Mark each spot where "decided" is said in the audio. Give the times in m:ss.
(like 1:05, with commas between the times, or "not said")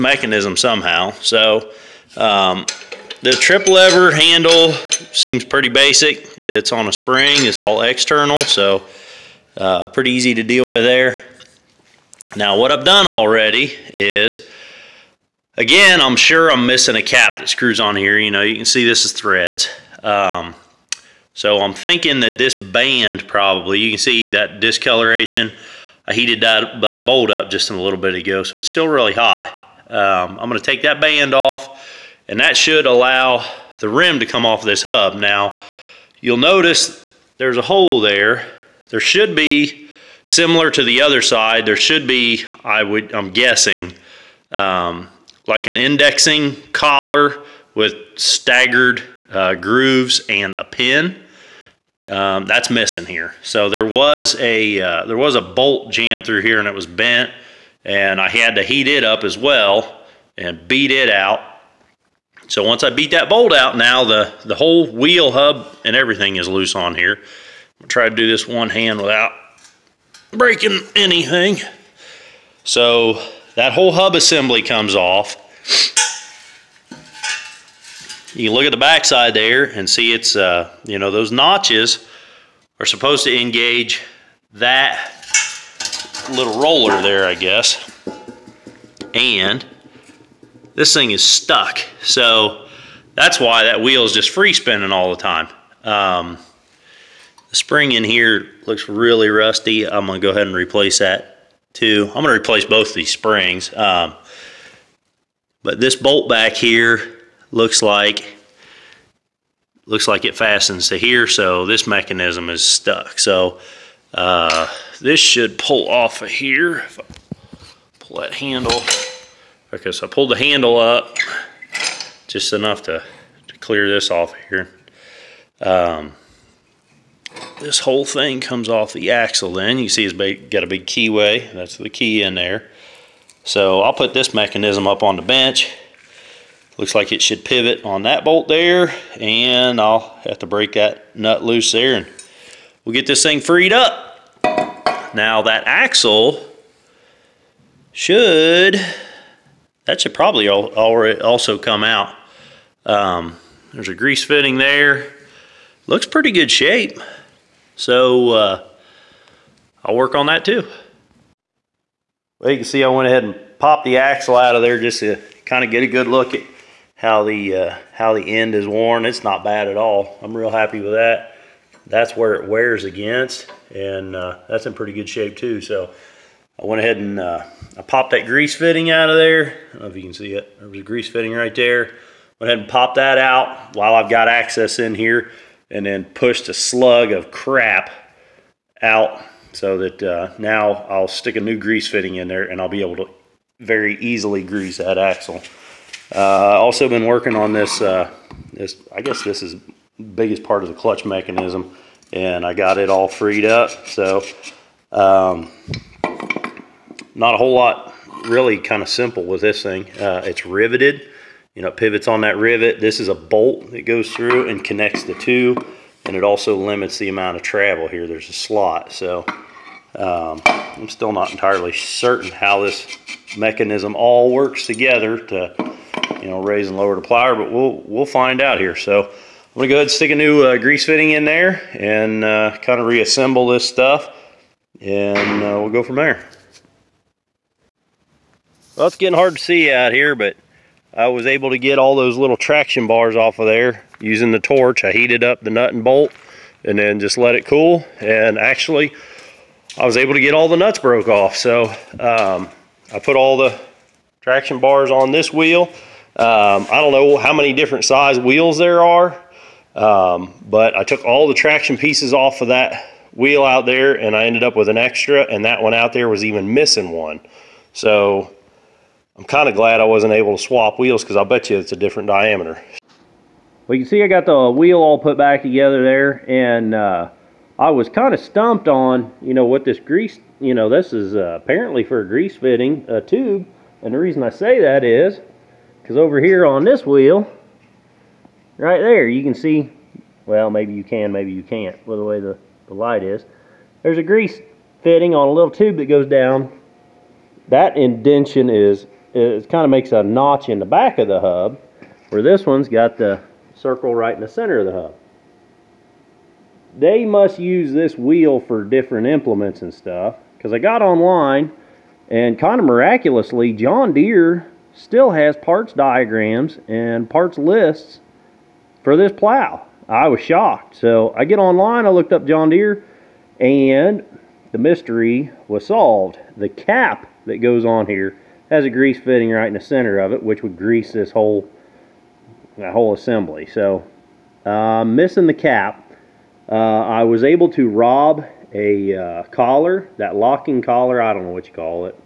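not said.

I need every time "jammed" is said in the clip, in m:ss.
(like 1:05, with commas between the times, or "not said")
0:55.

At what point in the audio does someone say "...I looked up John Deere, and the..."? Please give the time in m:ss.
5:21.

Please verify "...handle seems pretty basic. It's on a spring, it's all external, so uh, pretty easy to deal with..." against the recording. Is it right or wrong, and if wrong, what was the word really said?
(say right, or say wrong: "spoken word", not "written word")
right.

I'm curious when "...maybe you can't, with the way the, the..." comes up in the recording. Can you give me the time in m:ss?
4:51.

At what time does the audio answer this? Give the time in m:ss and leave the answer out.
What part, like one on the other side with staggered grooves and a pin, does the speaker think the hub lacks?
0:45.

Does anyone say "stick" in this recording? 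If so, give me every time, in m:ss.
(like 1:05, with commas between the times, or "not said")
3:11, 3:49.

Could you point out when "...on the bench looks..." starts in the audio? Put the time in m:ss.
2:15.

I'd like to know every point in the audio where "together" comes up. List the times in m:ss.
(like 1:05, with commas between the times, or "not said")
3:44, 4:35.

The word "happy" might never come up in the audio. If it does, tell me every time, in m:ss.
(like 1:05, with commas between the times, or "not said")
2:50.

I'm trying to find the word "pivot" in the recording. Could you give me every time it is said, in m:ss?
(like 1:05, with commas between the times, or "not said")
2:17, 3:31.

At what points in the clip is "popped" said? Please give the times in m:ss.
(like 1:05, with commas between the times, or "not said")
2:43, 2:57, 3:02.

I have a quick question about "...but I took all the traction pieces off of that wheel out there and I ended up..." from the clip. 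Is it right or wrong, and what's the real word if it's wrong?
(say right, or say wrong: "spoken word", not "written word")
right.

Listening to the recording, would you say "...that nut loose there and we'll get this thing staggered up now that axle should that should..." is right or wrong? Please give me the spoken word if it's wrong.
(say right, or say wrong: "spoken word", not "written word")
wrong: "freed", not "staggered".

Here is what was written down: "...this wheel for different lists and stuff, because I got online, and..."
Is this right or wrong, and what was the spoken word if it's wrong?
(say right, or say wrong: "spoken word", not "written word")
wrong: "implements", not "lists".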